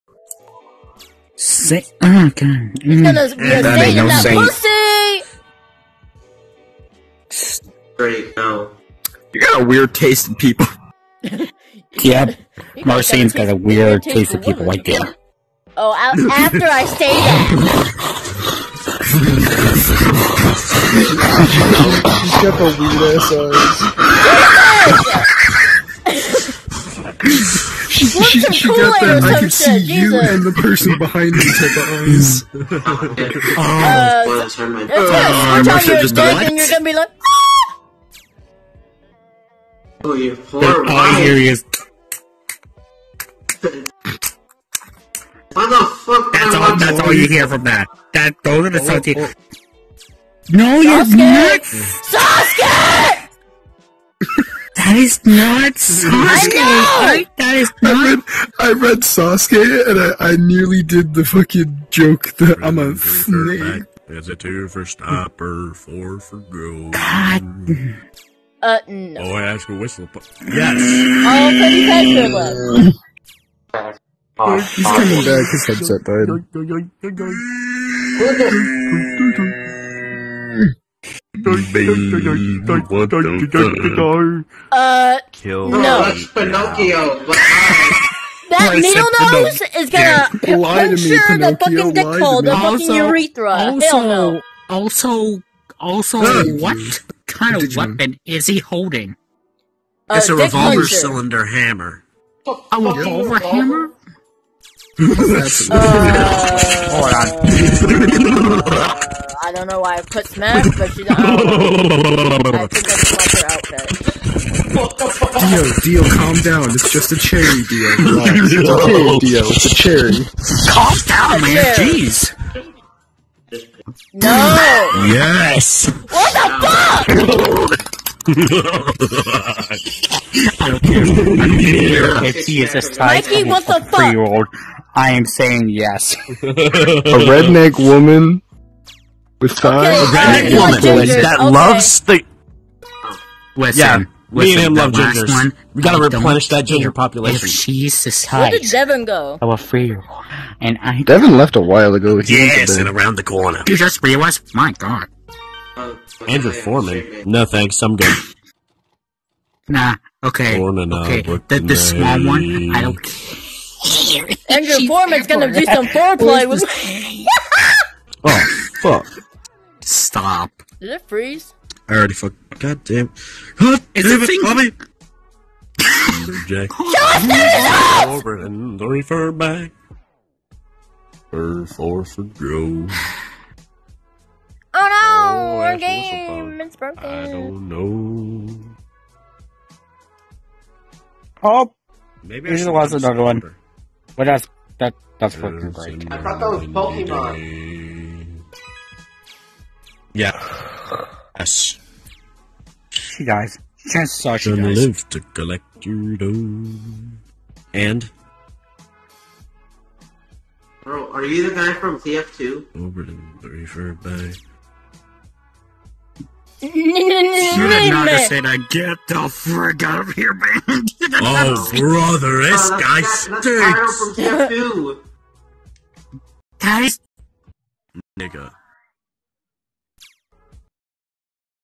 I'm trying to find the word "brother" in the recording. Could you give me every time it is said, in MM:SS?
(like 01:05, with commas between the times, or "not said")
03:41.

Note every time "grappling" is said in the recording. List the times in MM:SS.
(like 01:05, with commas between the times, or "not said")
not said.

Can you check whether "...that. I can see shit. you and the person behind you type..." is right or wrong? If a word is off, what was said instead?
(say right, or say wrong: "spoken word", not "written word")
right.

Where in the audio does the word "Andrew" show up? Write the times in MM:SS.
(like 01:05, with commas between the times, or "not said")
02:36, 02:44.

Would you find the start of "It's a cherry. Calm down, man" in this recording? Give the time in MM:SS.
01:59.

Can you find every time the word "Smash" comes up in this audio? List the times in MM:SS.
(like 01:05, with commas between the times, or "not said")
01:50.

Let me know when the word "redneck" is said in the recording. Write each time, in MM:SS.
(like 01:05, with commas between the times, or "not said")
02:16.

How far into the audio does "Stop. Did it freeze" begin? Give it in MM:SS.
02:50.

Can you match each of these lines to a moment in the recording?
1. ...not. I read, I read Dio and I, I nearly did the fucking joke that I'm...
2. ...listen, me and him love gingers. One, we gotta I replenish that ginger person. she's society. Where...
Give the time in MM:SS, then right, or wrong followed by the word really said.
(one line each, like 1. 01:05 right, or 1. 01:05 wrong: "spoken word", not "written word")
1. 00:57 wrong: "Sasuke", not "Dio"
2. 02:24 wrong: "population", not "person".